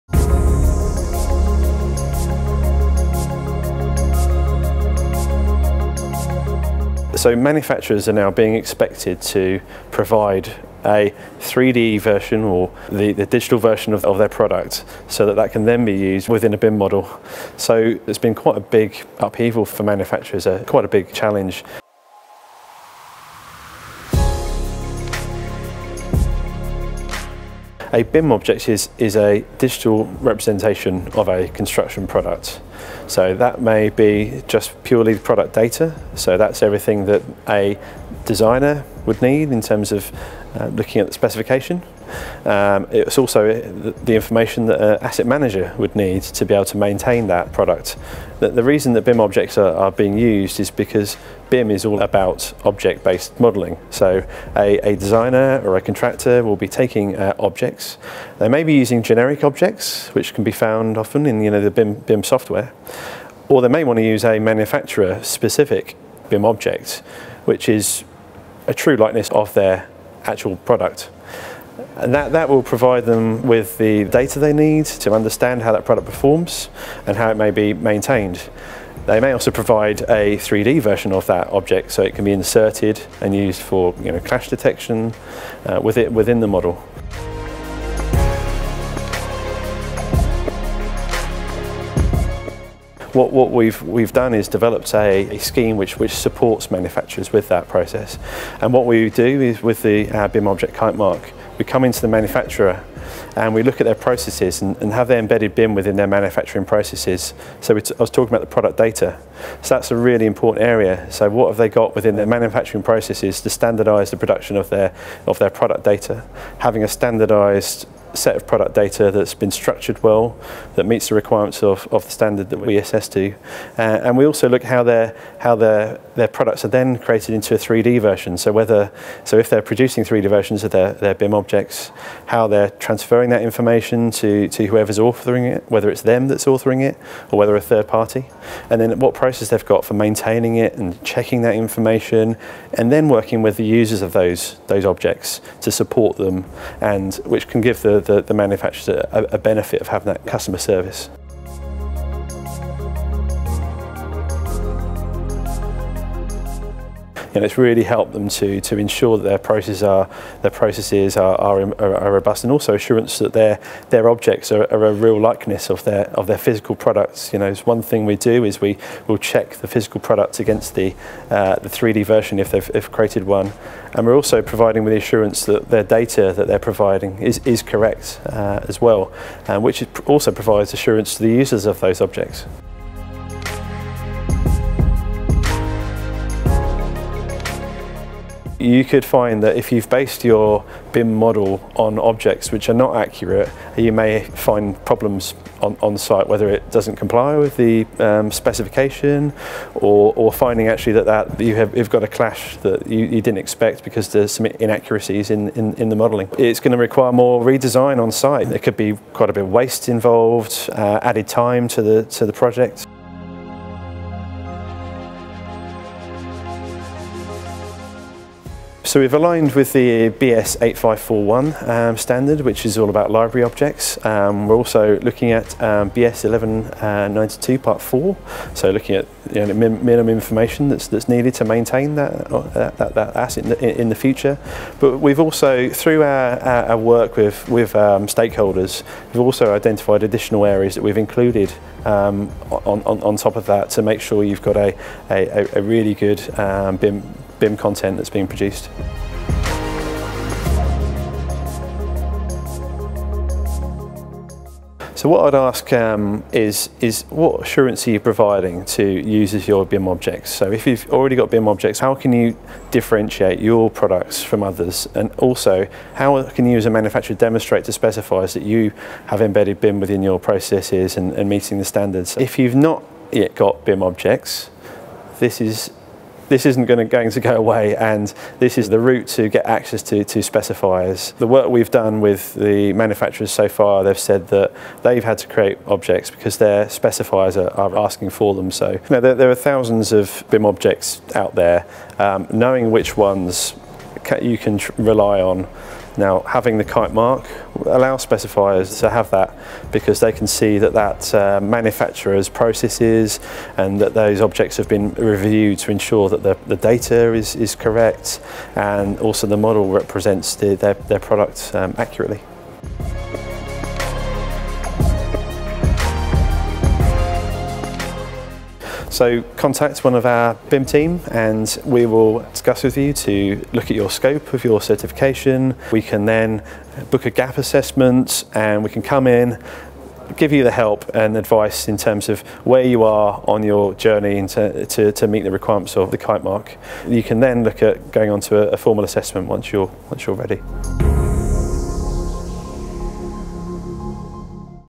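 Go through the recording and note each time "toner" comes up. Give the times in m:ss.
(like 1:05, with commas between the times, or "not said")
not said.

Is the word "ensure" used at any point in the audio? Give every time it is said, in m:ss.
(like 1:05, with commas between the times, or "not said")
2:38, 5:05.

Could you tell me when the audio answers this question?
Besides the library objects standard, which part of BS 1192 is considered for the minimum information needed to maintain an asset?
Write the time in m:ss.
3:47.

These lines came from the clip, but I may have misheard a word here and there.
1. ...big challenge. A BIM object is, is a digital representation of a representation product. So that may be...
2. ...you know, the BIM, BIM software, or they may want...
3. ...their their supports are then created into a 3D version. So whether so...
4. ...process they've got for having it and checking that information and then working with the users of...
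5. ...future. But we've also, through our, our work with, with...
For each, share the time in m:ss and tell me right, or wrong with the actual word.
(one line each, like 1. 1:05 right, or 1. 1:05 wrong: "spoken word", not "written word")
1. 0:20 wrong: "construction", not "representation"
2. 1:01 right
3. 2:05 wrong: "products", not "supports"
4. 2:19 wrong: "maintaining", not "having"
5. 3:53 right.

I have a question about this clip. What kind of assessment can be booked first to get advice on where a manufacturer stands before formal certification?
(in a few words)
gap assessment.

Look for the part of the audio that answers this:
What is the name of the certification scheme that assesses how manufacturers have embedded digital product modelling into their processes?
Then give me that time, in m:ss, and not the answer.
1:40.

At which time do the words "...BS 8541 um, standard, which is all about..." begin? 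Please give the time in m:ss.
3:40.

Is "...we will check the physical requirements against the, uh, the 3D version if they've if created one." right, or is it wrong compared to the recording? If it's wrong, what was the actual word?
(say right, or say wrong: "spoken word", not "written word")
wrong: "products", not "requirements".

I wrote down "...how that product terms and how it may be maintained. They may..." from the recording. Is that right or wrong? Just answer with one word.
wrong.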